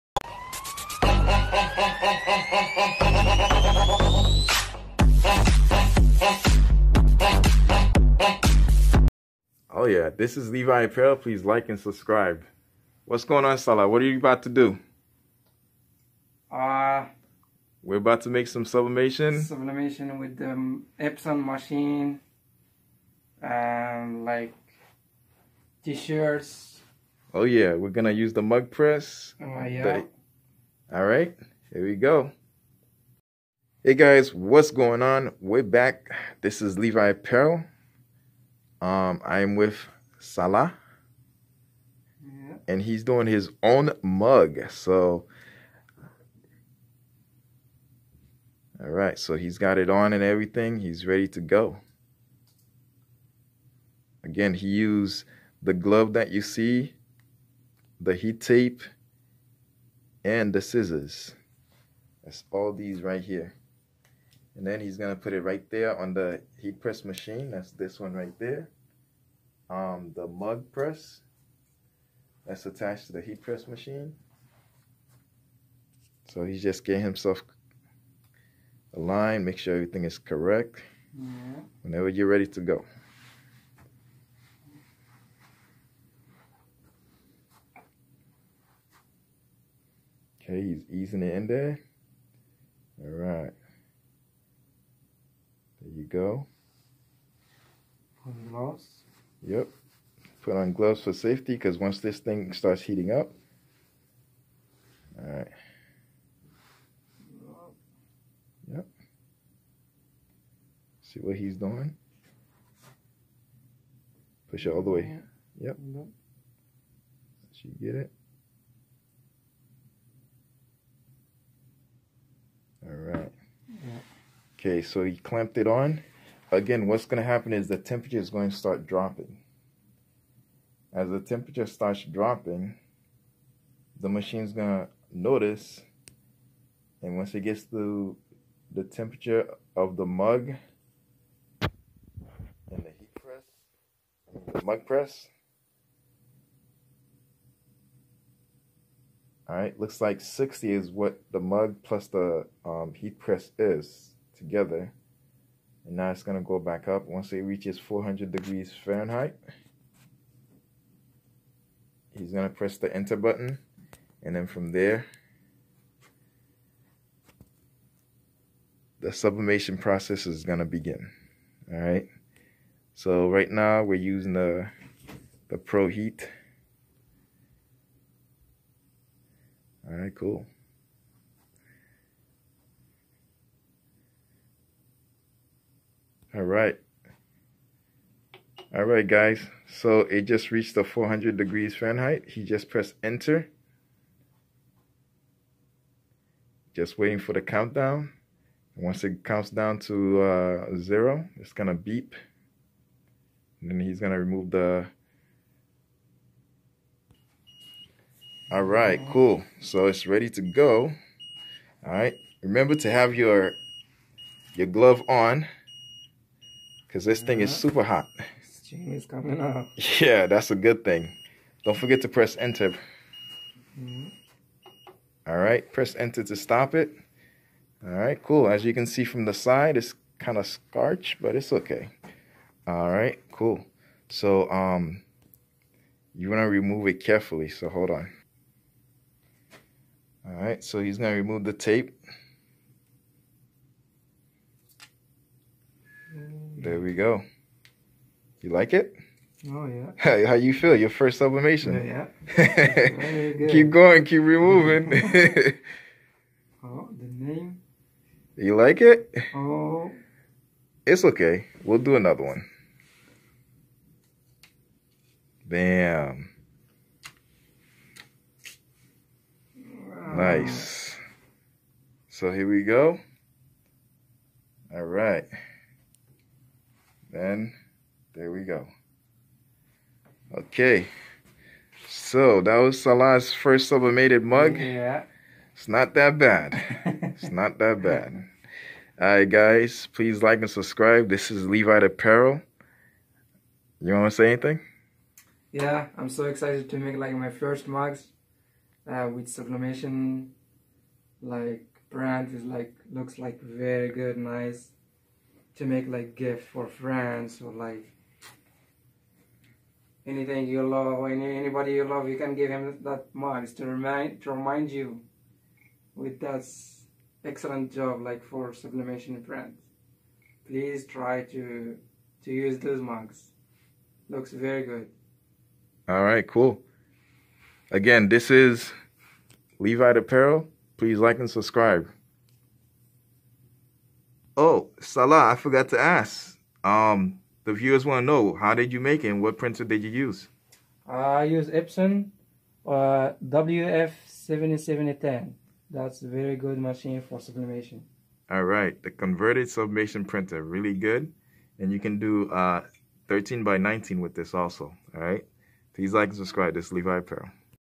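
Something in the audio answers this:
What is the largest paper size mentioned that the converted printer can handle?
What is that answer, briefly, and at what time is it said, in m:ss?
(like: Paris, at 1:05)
13 by 19, at 5:53.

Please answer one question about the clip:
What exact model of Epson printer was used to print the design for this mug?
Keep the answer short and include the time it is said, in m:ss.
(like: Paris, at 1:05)
WF7710, at 5:43.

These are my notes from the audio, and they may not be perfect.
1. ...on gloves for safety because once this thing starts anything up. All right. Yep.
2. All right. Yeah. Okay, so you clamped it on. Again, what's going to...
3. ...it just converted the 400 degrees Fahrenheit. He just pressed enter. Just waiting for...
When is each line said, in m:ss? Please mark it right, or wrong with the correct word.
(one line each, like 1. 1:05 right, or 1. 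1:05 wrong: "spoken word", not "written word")
1. 1:40 wrong: "heating", not "anything"
2. 2:02 right
3. 3:10 wrong: "reached", not "converted".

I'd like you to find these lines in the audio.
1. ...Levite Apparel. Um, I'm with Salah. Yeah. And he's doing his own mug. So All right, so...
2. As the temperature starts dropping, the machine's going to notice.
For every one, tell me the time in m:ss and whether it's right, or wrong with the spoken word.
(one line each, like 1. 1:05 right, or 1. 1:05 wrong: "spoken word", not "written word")
1. 0:36 right
2. 2:10 right.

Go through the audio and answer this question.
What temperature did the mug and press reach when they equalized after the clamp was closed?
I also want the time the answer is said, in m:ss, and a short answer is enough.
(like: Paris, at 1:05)
60, at 2:30.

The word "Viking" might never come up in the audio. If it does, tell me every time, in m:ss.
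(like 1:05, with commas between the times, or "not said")
not said.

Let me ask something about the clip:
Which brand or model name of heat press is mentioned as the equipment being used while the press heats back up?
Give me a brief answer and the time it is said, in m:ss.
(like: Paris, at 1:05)
Pro Heat, at 2:55.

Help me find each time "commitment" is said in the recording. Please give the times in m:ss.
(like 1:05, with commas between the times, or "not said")
not said.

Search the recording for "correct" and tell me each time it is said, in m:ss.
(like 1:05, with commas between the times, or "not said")
1:20.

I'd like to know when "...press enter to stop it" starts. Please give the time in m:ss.
3:45.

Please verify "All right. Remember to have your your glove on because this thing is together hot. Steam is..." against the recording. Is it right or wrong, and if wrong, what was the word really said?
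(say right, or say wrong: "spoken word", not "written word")
wrong: "super", not "together".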